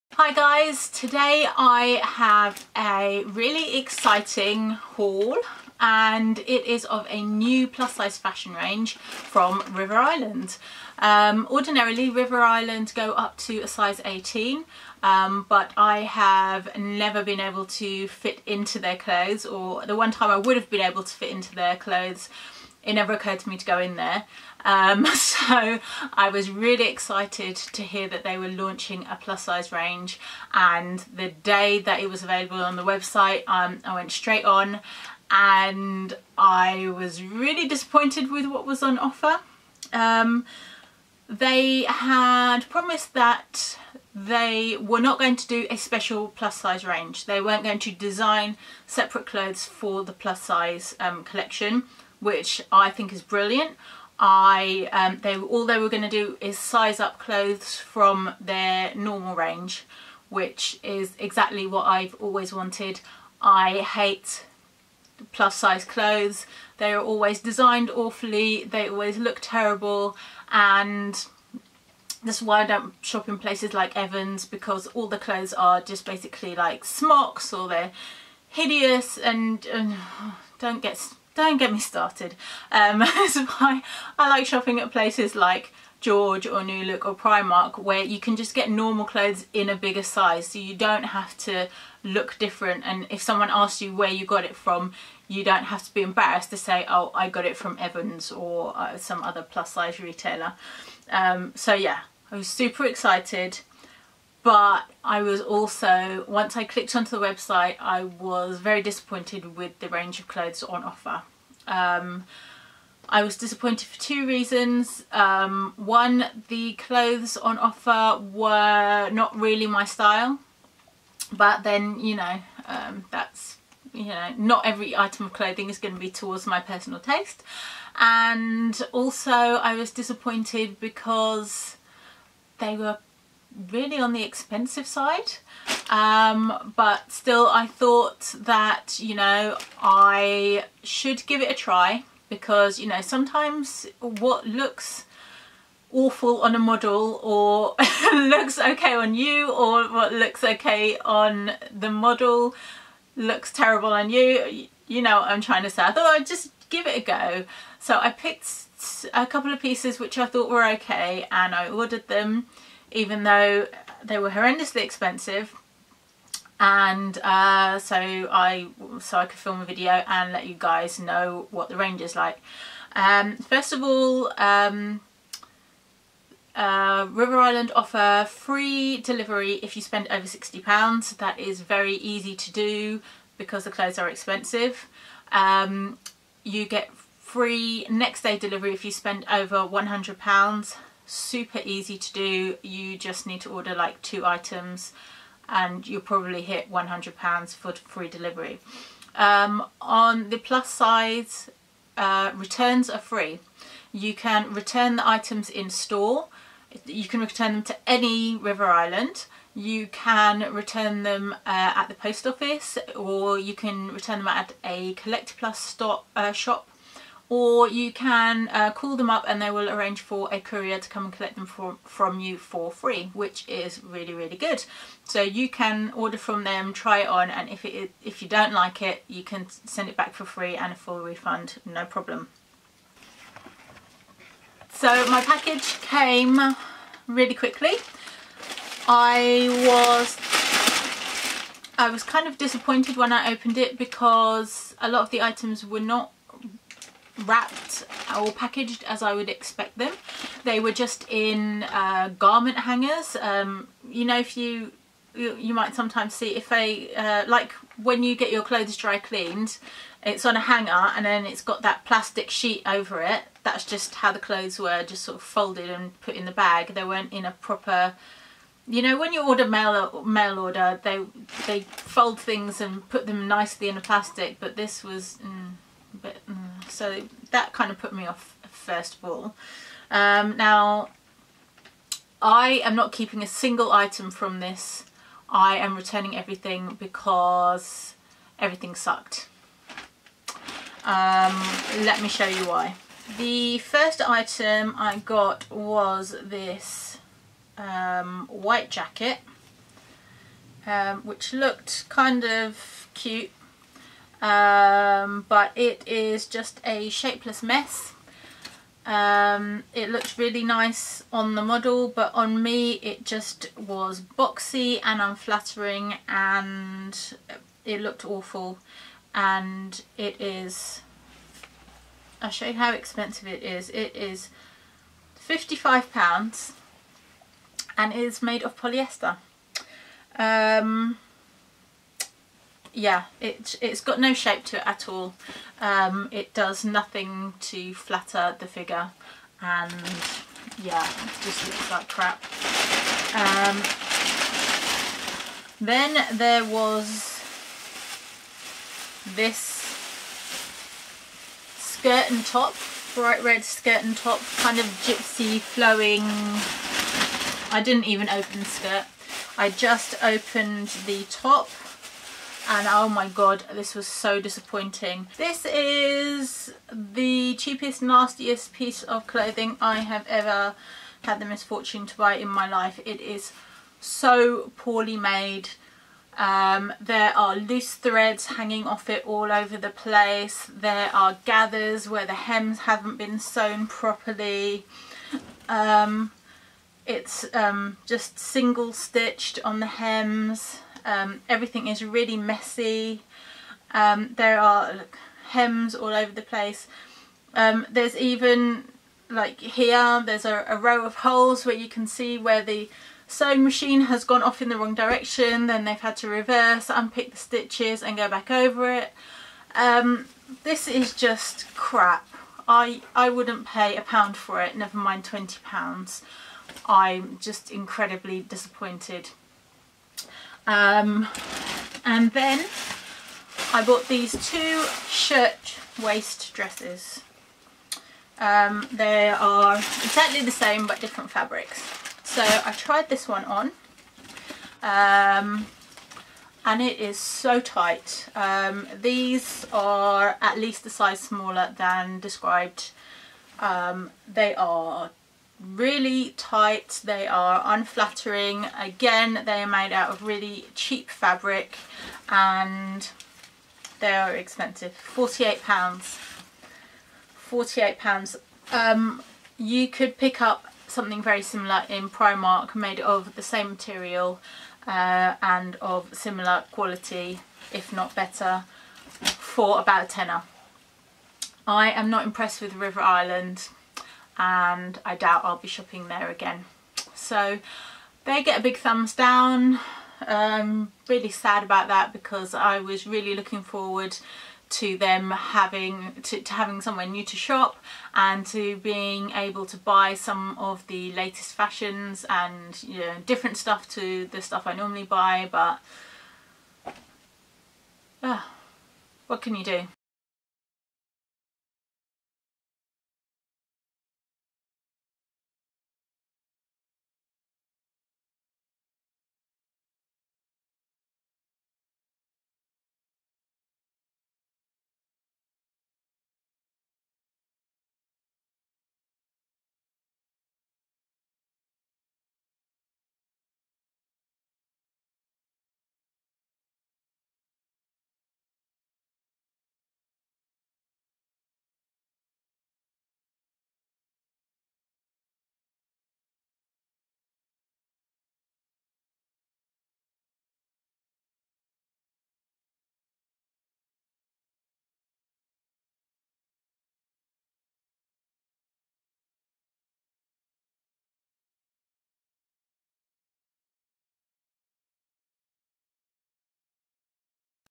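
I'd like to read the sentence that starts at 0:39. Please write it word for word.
Um, they had promised that they were not going to do a special plus size range.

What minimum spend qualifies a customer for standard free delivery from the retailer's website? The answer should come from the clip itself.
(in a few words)
£60.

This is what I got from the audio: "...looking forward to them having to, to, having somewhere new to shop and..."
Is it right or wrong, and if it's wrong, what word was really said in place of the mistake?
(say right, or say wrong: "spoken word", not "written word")
right.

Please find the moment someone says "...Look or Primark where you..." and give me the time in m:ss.
1:26.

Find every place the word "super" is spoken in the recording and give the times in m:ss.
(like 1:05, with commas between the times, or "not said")
1:42, 3:11.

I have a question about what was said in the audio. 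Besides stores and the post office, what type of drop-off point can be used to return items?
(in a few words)
Collect Plus.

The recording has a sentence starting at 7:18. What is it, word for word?
Um, these are at least a size smaller than described.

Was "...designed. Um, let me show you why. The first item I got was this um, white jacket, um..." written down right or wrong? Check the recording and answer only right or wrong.
wrong.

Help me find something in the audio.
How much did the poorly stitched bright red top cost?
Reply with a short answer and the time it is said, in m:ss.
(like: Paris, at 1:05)
£20, at 6:55.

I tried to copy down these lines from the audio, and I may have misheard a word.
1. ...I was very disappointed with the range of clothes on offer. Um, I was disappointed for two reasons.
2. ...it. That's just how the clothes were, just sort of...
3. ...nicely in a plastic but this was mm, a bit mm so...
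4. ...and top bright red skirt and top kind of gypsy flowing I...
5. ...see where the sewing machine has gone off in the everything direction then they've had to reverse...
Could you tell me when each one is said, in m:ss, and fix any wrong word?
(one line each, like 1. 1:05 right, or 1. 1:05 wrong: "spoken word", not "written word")
1. 1:47 right
2. 4:23 right
3. 4:33 right
4. 5:52 right
5. 6:41 wrong: "wrong", not "everything".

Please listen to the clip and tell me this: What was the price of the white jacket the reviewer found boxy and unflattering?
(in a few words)
£55.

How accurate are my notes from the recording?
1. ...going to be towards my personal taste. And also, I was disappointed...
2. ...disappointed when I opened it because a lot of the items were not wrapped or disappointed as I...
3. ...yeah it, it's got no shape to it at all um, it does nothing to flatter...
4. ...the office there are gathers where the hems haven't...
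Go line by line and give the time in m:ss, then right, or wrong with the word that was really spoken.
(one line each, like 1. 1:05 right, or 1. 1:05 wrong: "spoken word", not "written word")
1. 2:05 right
2. 4:02 wrong: "packaged", not "disappointed"
3. 5:32 right
4. 6:19 wrong: "place", not "office".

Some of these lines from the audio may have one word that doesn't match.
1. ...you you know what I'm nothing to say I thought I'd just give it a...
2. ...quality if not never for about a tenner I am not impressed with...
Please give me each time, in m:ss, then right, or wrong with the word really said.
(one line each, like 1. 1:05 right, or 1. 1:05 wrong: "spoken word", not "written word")
1. 2:34 wrong: "trying", not "nothing"
2. 7:46 wrong: "better", not "never".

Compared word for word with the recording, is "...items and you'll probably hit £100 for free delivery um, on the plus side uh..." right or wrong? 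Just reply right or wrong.
right.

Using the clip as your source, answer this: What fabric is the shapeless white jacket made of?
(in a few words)
polyester.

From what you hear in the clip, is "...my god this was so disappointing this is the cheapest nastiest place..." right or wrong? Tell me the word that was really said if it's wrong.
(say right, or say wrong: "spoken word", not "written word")
wrong: "piece", not "place".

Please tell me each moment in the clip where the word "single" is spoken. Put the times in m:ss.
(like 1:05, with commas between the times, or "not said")
4:43, 6:28.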